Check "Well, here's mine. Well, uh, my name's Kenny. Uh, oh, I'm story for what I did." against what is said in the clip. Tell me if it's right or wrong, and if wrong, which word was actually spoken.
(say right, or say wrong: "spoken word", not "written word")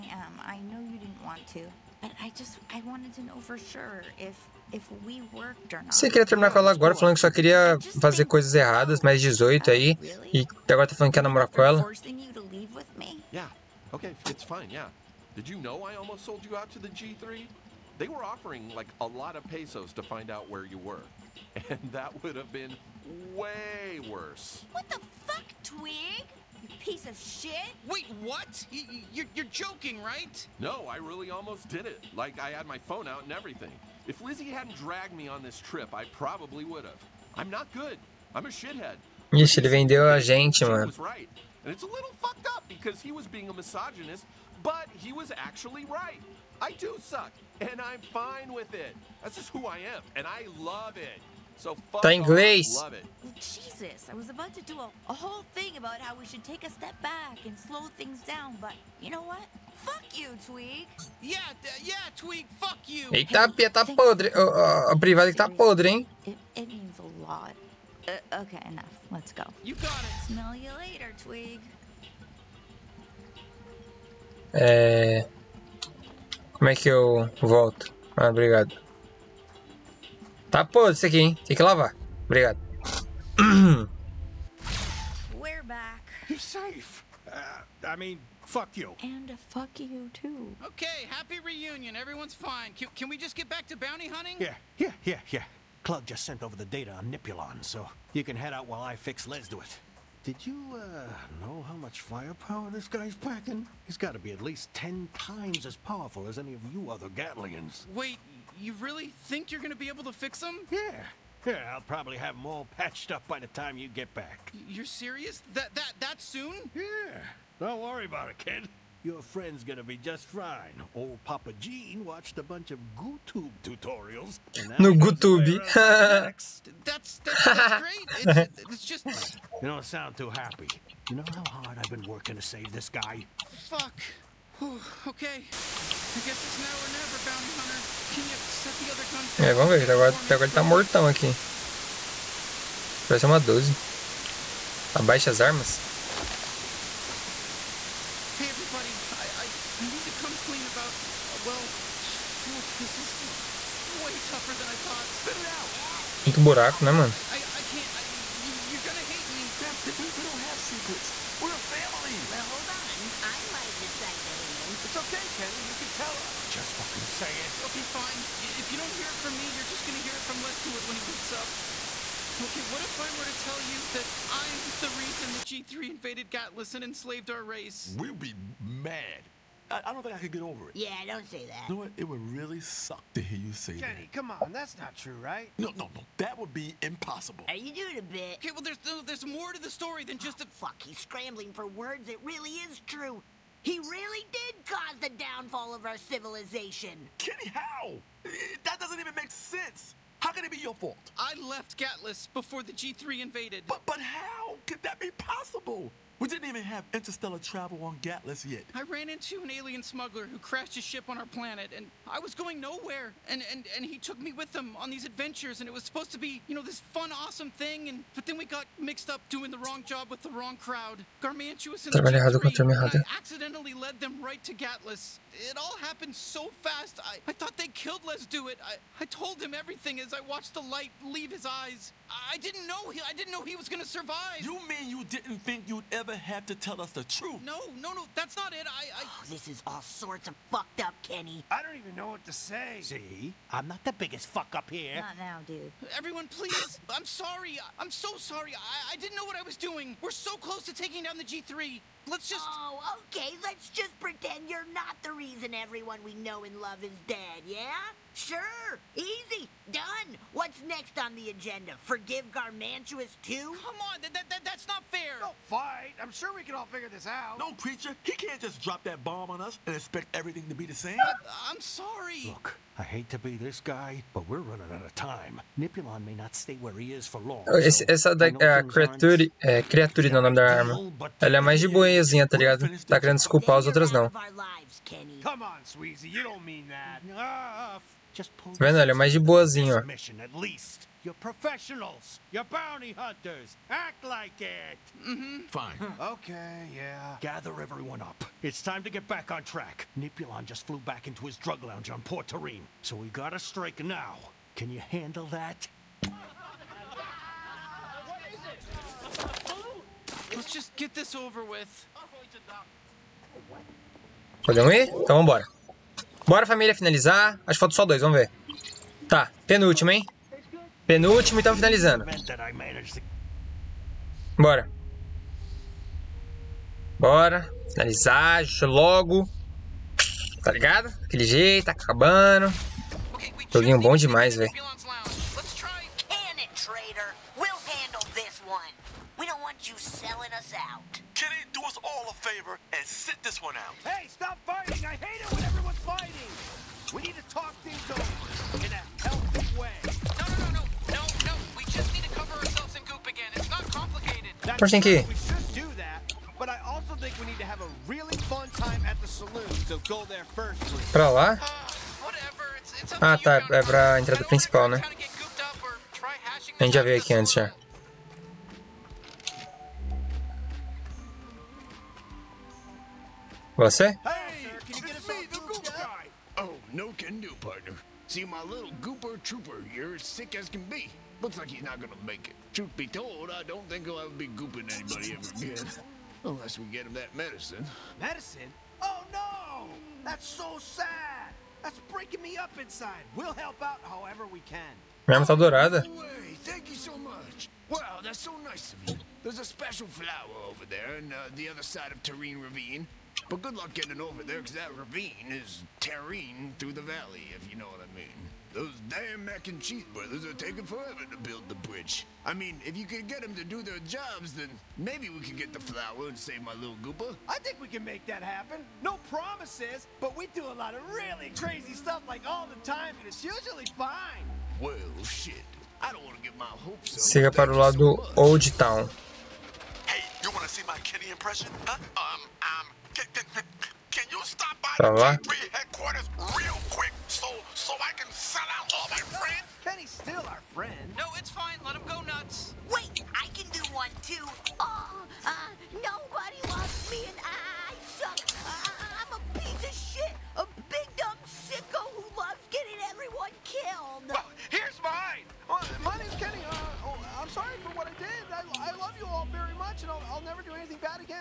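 wrong: "sorry", not "story".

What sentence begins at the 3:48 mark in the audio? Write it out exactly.
I, I told him everything as I watched the light leave his eyes.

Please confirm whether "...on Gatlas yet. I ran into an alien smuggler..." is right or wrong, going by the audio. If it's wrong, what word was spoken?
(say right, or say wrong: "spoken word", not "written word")
right.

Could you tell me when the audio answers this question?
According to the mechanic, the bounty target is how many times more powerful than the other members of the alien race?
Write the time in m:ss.
1:44.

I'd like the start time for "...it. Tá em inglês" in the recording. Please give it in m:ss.
0:50.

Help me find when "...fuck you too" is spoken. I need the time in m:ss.
1:29.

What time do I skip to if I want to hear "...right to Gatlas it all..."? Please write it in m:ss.
3:44.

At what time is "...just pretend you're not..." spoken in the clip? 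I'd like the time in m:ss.
4:13.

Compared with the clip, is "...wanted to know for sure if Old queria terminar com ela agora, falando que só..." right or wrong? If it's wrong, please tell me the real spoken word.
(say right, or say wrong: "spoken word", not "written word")
wrong: "Você", not "Old".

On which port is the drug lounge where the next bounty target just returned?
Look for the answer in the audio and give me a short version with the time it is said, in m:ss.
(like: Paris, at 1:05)
Port Terrine, at 5:02.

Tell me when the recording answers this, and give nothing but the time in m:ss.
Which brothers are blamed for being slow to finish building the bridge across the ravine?
6:49.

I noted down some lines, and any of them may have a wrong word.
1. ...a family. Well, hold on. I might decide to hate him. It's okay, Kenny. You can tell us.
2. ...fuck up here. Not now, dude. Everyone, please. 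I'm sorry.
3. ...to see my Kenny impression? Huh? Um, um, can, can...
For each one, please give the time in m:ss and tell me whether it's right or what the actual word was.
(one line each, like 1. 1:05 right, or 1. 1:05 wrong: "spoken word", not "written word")
1. 2:41 right
2. 4:04 right
3. 7:10 right.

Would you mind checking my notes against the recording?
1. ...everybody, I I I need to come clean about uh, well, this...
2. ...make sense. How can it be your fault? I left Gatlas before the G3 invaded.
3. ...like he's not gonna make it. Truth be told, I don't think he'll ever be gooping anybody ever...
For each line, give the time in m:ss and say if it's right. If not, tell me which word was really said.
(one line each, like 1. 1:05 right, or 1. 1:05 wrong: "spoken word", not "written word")
1. 2:28 right
2. 3:19 right
3. 6:21 right.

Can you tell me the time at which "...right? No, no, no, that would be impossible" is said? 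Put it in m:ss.
3:05.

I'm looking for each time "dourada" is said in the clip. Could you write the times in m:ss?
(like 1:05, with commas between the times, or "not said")
6:35.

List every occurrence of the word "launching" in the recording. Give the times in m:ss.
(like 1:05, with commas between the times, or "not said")
not said.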